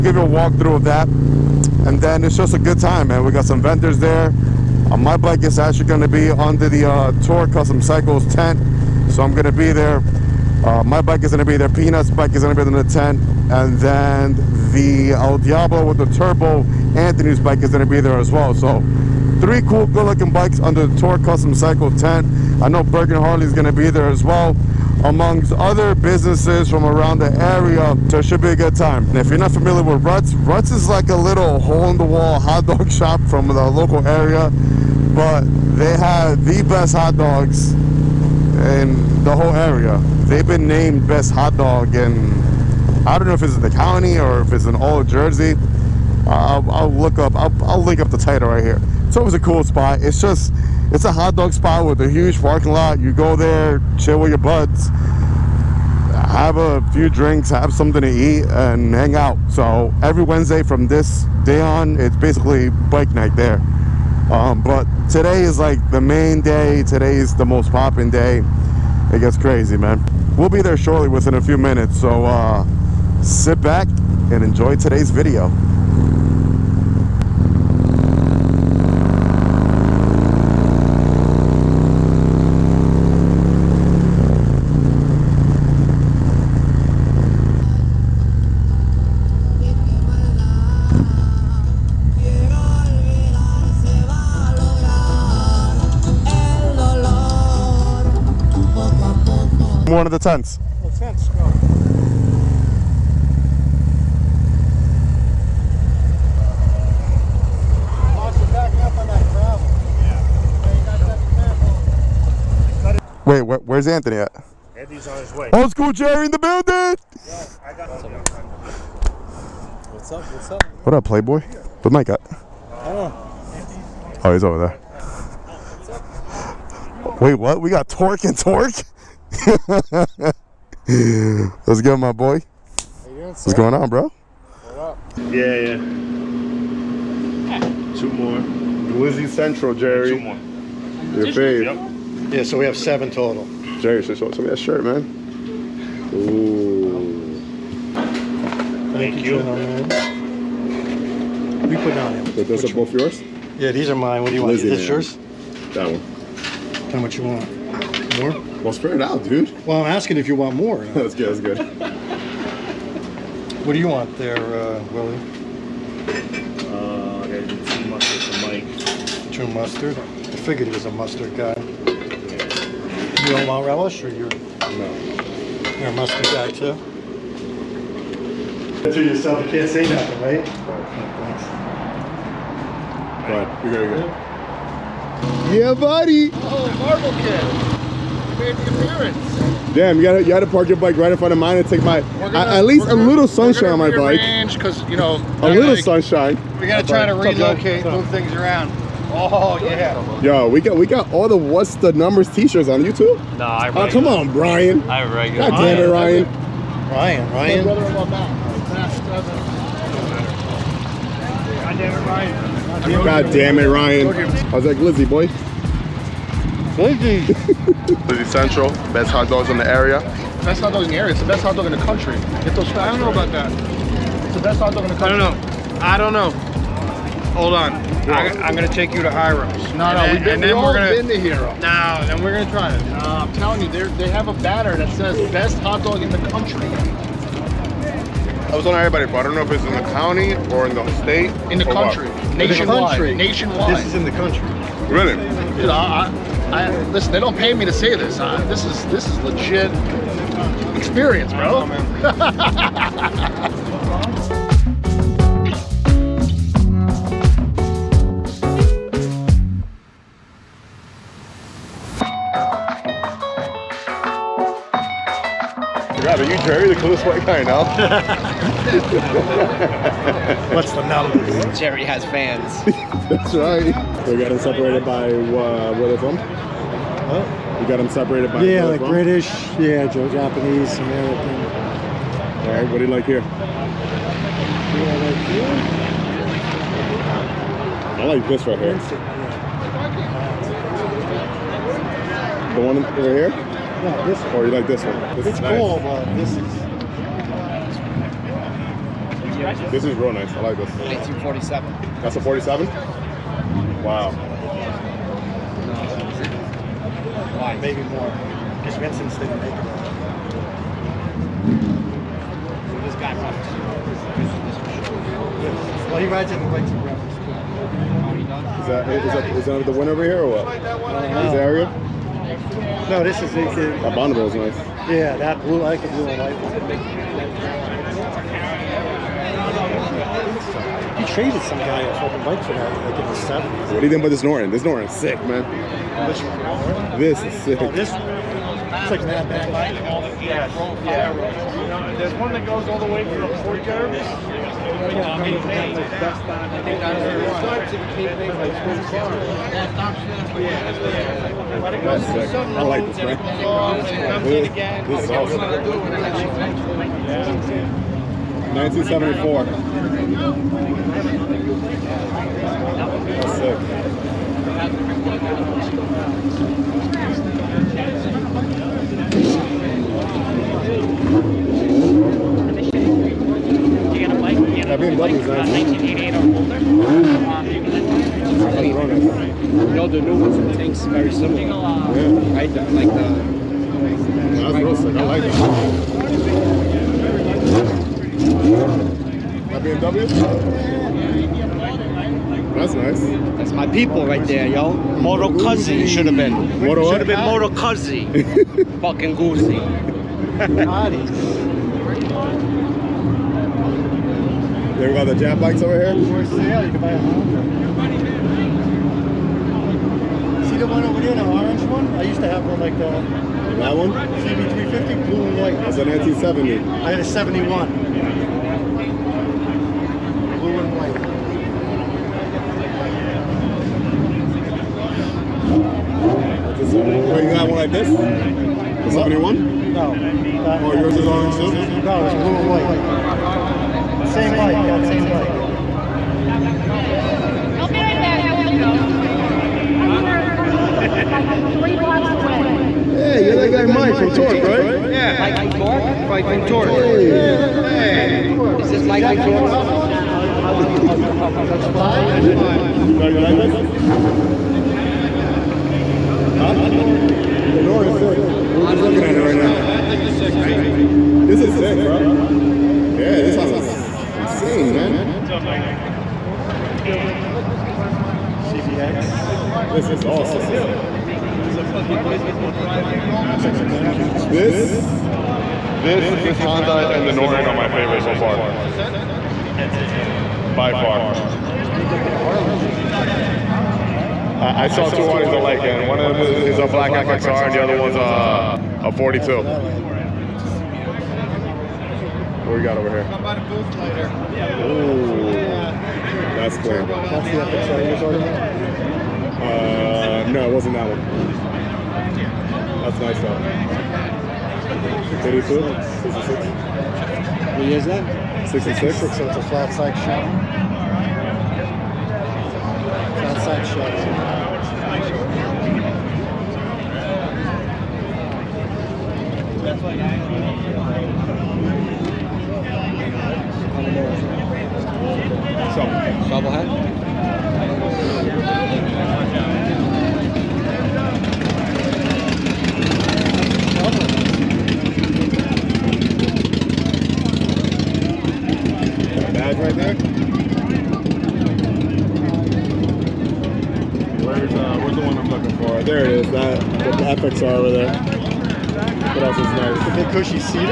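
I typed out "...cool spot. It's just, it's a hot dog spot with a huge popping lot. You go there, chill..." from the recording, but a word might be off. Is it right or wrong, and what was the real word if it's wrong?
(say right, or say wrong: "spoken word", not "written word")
wrong: "parking", not "popping".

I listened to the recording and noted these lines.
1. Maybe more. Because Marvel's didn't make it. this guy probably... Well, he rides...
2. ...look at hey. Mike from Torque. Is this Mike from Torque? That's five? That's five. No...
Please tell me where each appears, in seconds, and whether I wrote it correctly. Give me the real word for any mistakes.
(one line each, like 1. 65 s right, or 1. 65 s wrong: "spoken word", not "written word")
1. 307 s wrong: "Vincent", not "Marvel"
2. 447 s right.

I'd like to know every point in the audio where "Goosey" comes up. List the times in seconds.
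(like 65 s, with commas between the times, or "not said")
399 s.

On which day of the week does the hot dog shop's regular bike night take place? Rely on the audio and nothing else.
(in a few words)
Wednesday.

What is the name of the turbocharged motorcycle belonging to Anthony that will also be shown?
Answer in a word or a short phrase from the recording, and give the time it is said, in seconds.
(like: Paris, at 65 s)
El Diablo, at 15 s.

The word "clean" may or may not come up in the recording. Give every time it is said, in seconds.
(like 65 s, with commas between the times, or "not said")
496 s.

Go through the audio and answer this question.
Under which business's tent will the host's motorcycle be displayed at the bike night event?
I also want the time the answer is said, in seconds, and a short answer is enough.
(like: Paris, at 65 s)
Torque Custom Cycles, at 7 s.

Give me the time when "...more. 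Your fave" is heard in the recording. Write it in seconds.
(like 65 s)
140 s.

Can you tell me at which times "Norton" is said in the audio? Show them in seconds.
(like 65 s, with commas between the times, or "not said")
334 s, 477 s.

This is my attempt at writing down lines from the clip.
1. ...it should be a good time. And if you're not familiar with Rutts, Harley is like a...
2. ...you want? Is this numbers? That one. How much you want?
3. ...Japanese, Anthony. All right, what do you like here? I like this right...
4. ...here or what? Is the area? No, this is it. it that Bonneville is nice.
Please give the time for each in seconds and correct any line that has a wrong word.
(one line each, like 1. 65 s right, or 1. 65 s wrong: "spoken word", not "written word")
1. 28 s wrong: "Rutts", not "Harley"
2. 154 s wrong: "yours", not "numbers"
3. 279 s wrong: "American", not "Anthony"
4. 320 s right.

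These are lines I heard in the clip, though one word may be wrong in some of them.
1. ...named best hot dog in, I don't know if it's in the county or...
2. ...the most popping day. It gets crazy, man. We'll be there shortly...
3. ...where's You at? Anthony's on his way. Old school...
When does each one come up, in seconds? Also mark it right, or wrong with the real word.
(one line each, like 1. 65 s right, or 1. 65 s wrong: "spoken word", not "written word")
1. 40 s right
2. 67 s right
3. 113 s wrong: "Anthony", not "You".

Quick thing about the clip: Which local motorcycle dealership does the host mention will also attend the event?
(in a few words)
Bergen Harley.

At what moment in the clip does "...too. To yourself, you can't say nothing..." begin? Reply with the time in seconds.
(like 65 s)
176 s.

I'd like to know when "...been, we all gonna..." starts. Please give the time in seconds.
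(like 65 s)
230 s.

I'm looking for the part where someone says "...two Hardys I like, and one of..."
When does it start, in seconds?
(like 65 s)
484 s.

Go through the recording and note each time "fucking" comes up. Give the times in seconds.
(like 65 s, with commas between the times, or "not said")
331 s, 398 s, 471 s.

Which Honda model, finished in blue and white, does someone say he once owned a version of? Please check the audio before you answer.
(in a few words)
CB350.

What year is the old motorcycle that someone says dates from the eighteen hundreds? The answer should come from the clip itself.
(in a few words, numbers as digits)
1847.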